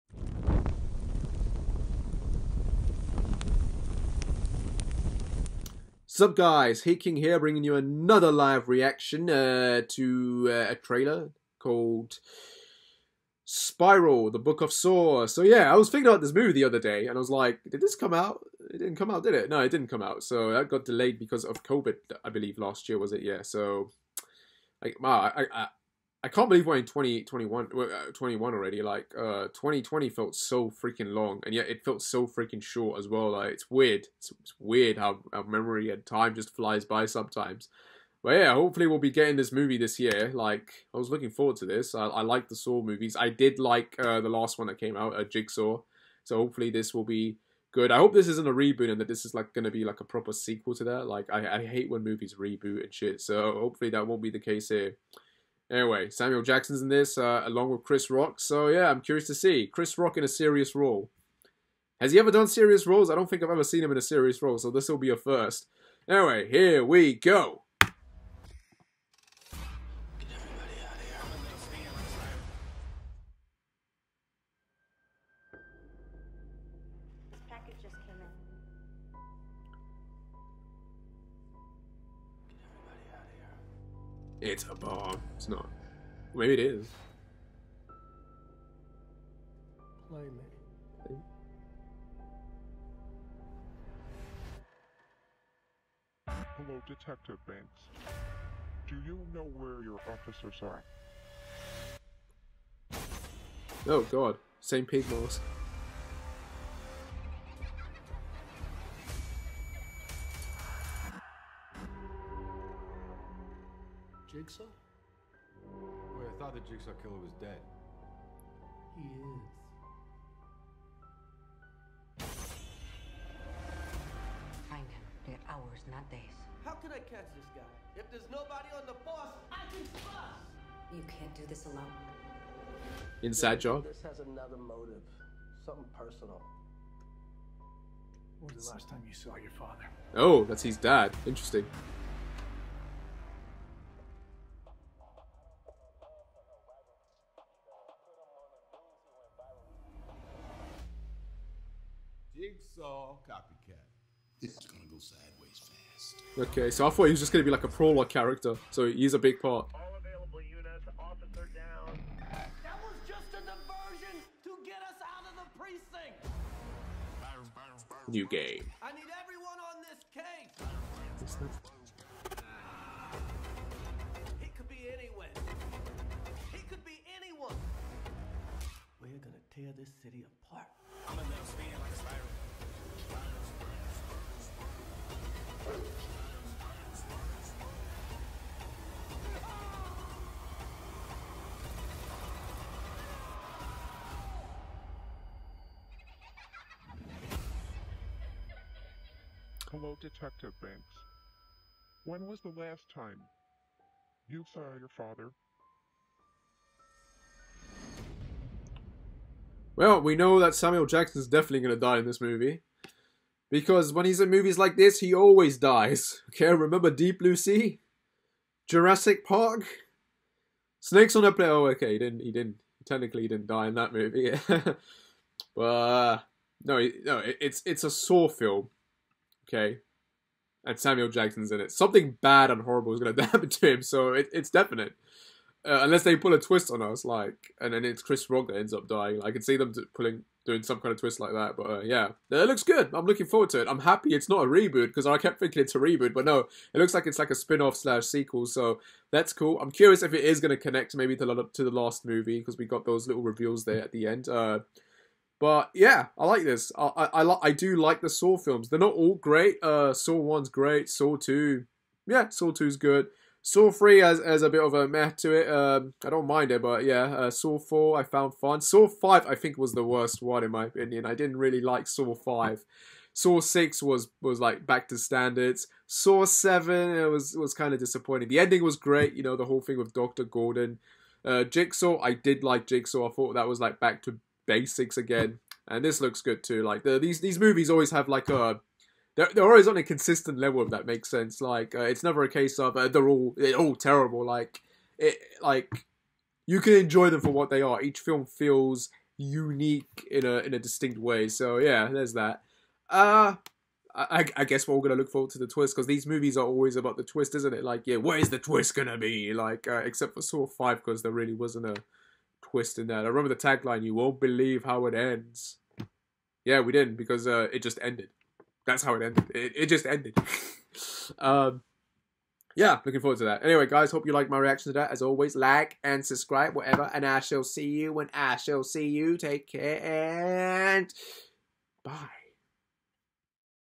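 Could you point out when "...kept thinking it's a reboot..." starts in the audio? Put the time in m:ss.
4:05.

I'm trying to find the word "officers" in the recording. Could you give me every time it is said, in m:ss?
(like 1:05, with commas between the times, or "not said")
1:40, 2:40.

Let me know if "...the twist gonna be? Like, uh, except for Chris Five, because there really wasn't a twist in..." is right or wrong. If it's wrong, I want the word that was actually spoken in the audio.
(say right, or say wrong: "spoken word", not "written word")
wrong: "Saw", not "Chris".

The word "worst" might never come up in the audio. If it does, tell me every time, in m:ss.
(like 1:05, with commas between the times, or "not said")
4:29.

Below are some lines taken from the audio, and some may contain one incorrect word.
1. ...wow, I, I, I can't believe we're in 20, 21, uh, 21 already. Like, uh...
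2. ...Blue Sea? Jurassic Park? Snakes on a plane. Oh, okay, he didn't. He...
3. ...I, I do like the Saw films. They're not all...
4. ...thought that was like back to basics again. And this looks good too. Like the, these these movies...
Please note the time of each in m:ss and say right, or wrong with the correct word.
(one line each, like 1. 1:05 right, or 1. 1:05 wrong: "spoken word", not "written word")
1. 0:25 right
2. 3:37 right
3. 4:17 right
4. 4:43 right.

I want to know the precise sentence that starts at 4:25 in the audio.
Um, I don't mind it, but yeah, uh, Saw four I found fun.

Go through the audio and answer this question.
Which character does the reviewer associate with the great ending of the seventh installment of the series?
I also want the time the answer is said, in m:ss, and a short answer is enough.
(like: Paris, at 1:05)
Doctor Gordon, at 4:39.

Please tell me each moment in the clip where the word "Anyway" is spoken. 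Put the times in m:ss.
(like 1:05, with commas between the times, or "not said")
0:55, 1:06, 5:23.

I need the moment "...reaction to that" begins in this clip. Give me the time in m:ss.
5:24.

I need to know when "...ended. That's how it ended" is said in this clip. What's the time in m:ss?
5:17.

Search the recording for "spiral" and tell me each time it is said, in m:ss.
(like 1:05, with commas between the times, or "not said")
0:13, 3:01.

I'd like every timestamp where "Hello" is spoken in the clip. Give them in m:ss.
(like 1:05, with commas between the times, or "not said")
1:36, 3:19.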